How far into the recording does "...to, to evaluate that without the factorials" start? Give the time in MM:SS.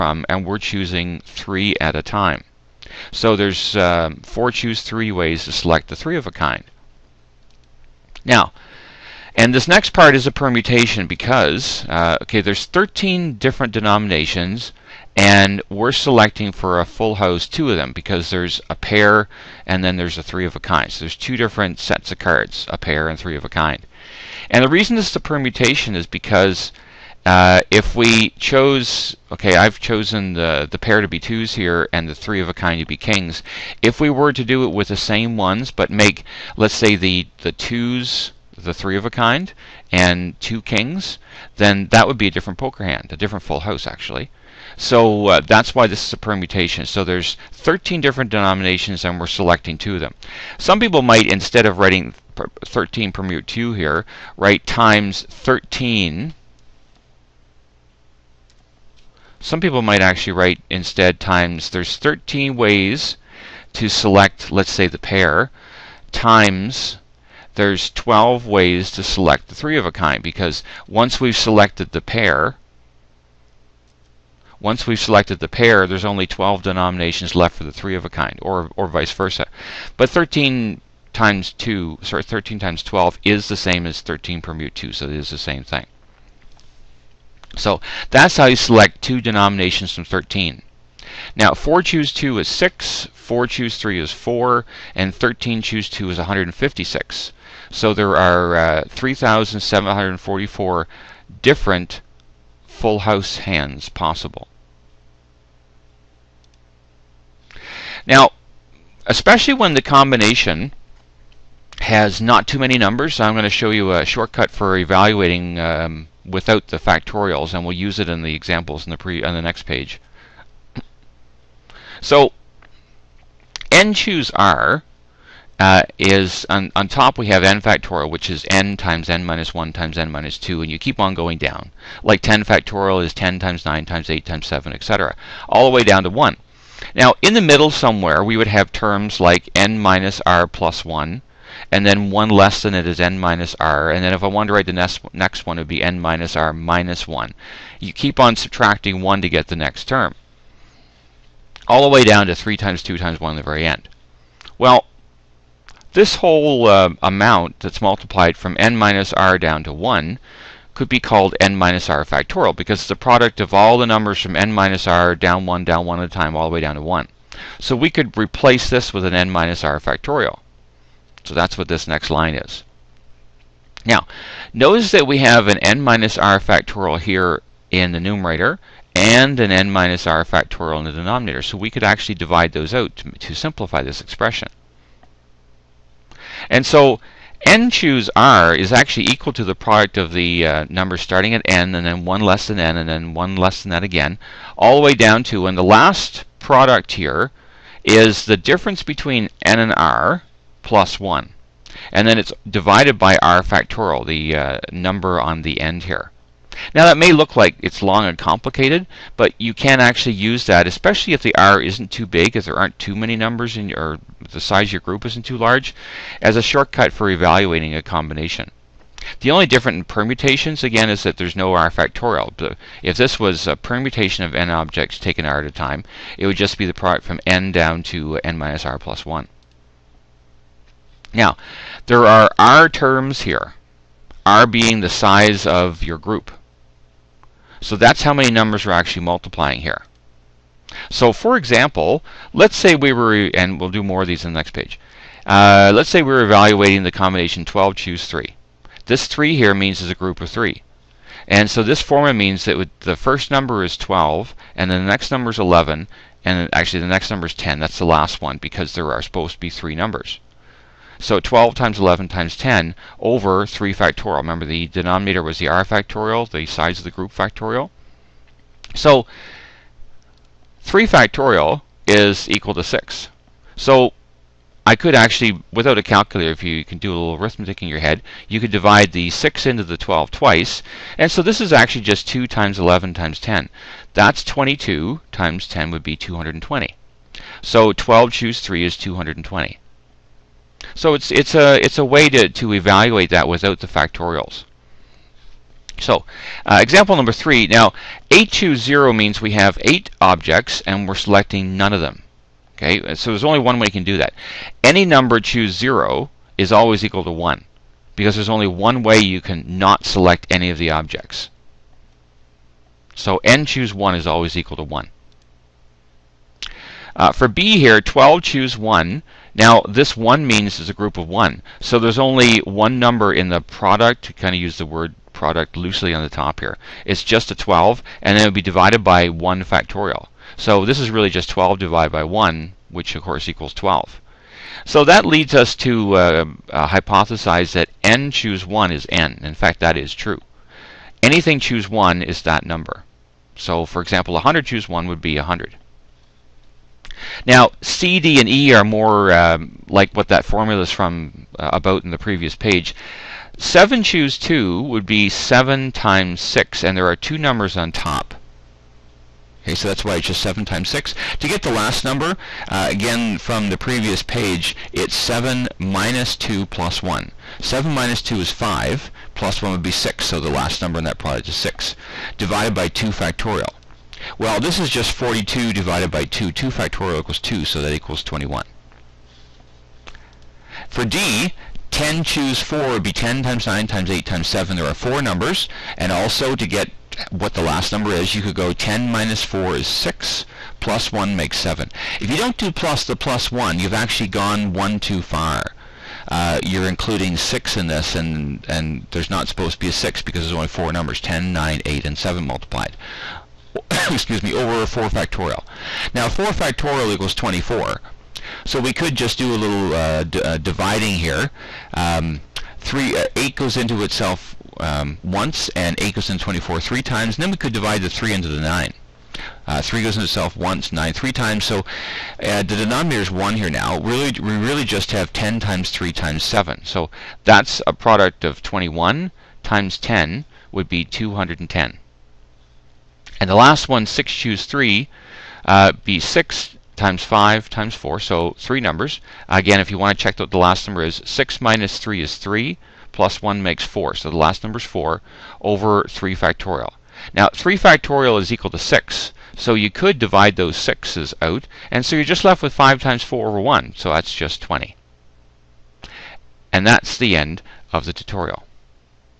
04:52.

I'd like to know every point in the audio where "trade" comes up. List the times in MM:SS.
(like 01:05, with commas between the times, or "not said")
not said.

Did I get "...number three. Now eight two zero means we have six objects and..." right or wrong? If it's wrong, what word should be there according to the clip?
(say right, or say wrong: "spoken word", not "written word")
wrong: "eight", not "six".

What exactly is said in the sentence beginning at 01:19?
But 13 times 2, sorry, 13 times 12 is the same as 13 permute 2, so it is the same thing.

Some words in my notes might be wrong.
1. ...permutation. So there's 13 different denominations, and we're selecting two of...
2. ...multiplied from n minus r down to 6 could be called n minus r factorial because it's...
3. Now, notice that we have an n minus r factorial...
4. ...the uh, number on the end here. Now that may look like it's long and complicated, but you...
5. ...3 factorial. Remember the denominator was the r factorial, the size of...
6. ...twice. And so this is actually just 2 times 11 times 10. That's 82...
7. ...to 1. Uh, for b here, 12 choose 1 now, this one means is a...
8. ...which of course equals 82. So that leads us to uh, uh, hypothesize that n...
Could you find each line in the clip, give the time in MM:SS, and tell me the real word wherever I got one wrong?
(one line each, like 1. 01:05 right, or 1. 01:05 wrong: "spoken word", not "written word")
1. 00:46 right
2. 02:37 wrong: "1", not "6"
3. 02:53 right
4. 03:24 right
5. 04:23 right
6. 04:40 wrong: "22", not "82"
7. 05:14 right
8. 05:32 wrong: "12", not "82".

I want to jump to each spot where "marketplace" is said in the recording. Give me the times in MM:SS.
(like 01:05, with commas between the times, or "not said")
not said.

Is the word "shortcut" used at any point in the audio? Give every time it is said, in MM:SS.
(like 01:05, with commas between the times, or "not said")
01:54, 03:36.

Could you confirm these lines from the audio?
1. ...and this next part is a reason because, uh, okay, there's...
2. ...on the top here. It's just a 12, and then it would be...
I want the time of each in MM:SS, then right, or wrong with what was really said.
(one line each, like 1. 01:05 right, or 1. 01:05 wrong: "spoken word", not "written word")
1. 00:09 wrong: "permutation", not "reason"
2. 05:25 right.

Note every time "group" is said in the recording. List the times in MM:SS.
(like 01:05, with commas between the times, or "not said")
03:34, 03:55, 04:09, 04:26, 05:20.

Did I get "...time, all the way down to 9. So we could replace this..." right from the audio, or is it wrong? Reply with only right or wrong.
wrong.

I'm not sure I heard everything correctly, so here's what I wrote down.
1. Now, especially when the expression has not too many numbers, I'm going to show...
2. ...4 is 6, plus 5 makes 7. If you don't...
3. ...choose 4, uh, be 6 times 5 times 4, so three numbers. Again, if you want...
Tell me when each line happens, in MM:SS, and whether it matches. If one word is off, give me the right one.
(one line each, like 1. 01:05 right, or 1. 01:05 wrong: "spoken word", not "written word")
1. 01:48 wrong: "combination", not "expression"
2. 06:29 wrong: "1", not "5"
3. 07:14 wrong: "3", not "4".